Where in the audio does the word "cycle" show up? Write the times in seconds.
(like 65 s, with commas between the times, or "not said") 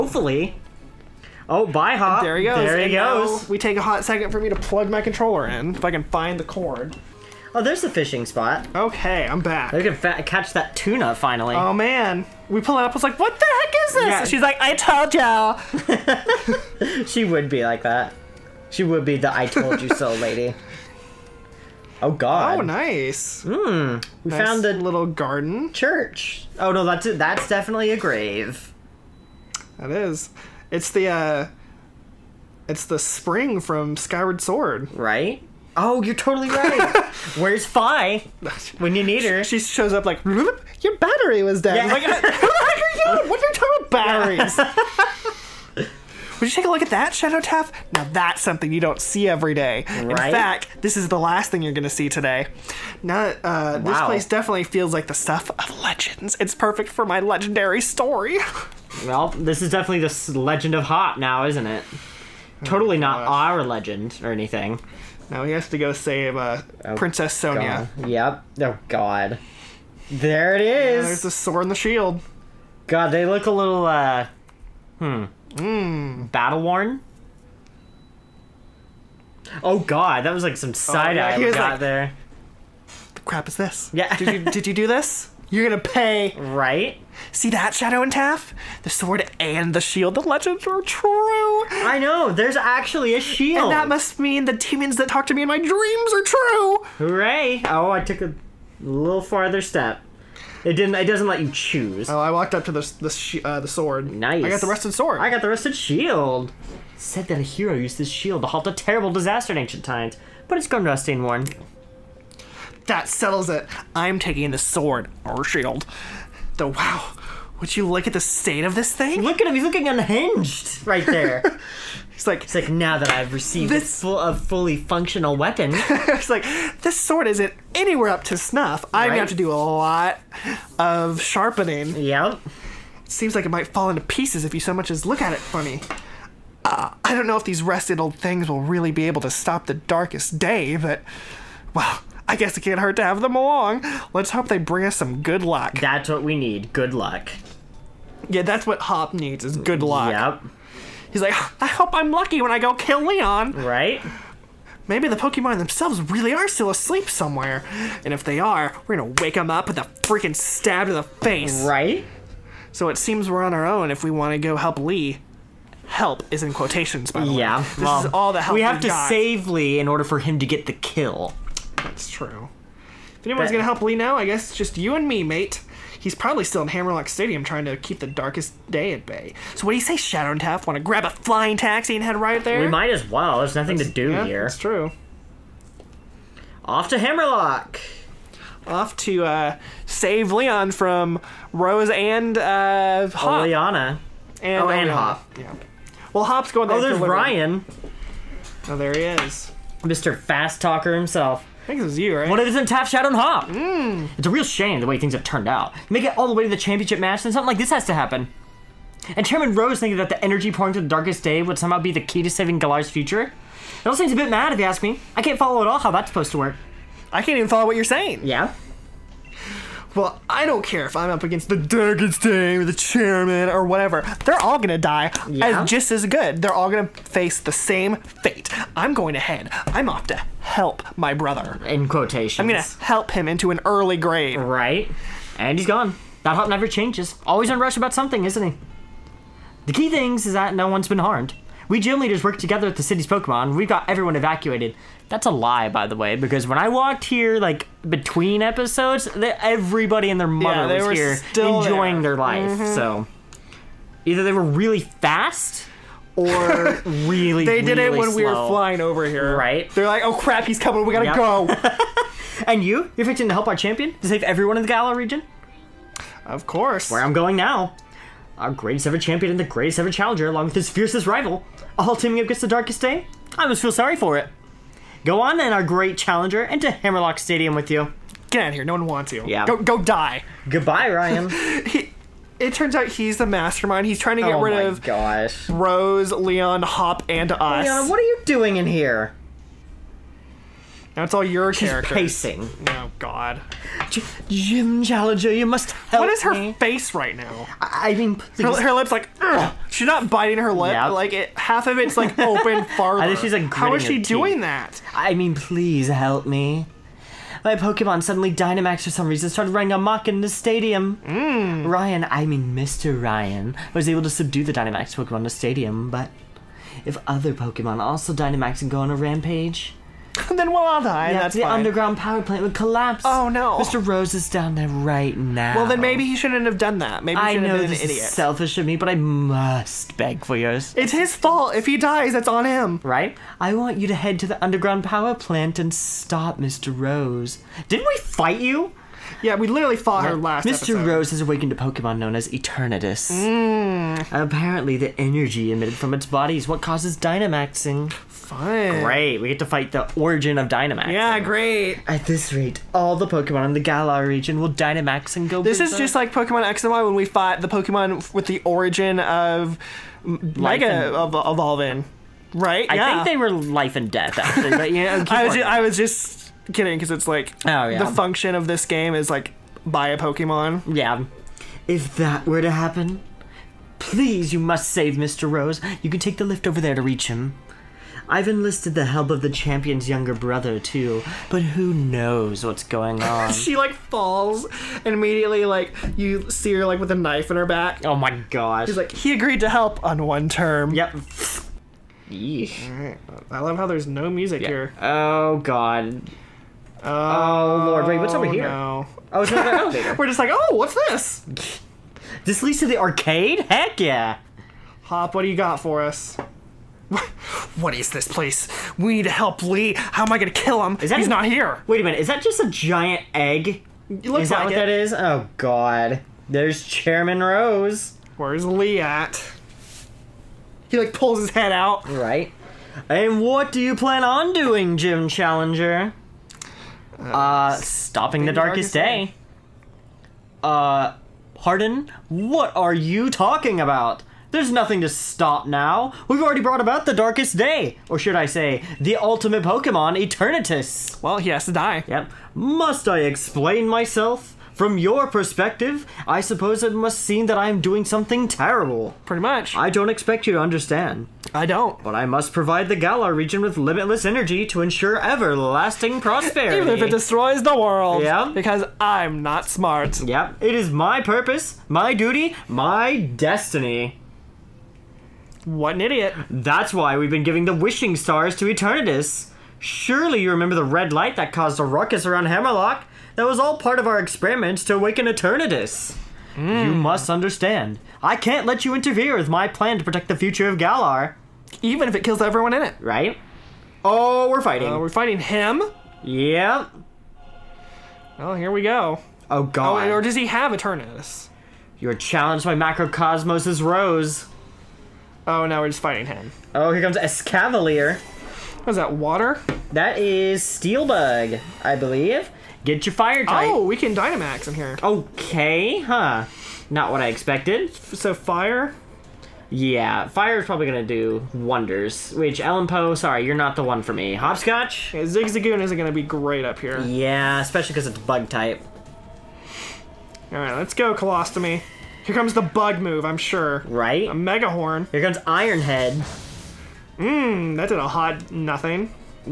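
not said.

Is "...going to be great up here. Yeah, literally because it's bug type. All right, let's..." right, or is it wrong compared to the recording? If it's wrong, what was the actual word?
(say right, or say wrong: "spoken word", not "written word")
wrong: "especially", not "literally".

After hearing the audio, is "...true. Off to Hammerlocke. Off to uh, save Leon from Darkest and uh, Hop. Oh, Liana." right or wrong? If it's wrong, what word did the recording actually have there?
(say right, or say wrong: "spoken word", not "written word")
wrong: "Rose", not "Darkest".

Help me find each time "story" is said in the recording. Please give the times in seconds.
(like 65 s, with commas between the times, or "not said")
57 s.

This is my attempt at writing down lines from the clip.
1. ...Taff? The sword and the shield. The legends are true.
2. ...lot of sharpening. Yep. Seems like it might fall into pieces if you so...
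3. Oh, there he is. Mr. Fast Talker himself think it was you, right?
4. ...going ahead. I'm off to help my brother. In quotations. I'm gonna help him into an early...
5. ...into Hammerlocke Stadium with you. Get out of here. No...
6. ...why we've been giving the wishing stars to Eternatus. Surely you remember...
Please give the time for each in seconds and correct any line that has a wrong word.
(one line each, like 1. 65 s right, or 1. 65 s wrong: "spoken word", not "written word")
1. 88 s right
2. 129 s right
3. 198 s right
4. 228 s right
5. 276 s right
6. 466 s right.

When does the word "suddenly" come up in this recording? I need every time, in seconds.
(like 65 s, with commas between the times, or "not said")
308 s.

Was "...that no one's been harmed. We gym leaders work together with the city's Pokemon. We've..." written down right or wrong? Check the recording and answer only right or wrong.
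right.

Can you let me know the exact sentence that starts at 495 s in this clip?
Oh, now we're just fighting him.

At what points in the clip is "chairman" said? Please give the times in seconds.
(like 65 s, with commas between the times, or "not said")
209 s, 222 s, 416 s.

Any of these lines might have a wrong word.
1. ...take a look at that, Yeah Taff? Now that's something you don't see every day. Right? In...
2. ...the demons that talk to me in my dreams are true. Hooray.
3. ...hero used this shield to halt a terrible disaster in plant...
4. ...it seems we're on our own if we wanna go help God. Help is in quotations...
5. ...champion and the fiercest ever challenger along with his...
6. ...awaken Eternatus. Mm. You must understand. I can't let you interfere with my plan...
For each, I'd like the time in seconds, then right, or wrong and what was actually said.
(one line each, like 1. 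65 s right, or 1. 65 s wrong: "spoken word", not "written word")
1. 46 s wrong: "Shadow", not "Yeah"
2. 94 s right
3. 107 s wrong: "ancient", not "plant"
4. 162 s wrong: "Lee", not "God"
5. 268 s wrong: "greatest", not "fiercest"
6. 474 s right.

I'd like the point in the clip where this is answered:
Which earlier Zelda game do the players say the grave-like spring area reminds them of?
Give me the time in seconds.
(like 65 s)
33 s.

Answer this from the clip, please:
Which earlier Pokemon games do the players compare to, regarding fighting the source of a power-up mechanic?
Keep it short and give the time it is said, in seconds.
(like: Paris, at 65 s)
Pokemon X and Y, at 356 s.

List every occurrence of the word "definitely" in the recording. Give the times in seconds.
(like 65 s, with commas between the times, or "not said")
27 s, 54 s, 59 s.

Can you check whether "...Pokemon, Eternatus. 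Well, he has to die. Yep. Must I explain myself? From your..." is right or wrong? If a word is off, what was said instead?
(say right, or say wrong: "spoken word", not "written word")
right.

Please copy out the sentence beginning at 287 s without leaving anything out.
Leon, what are you doing in here?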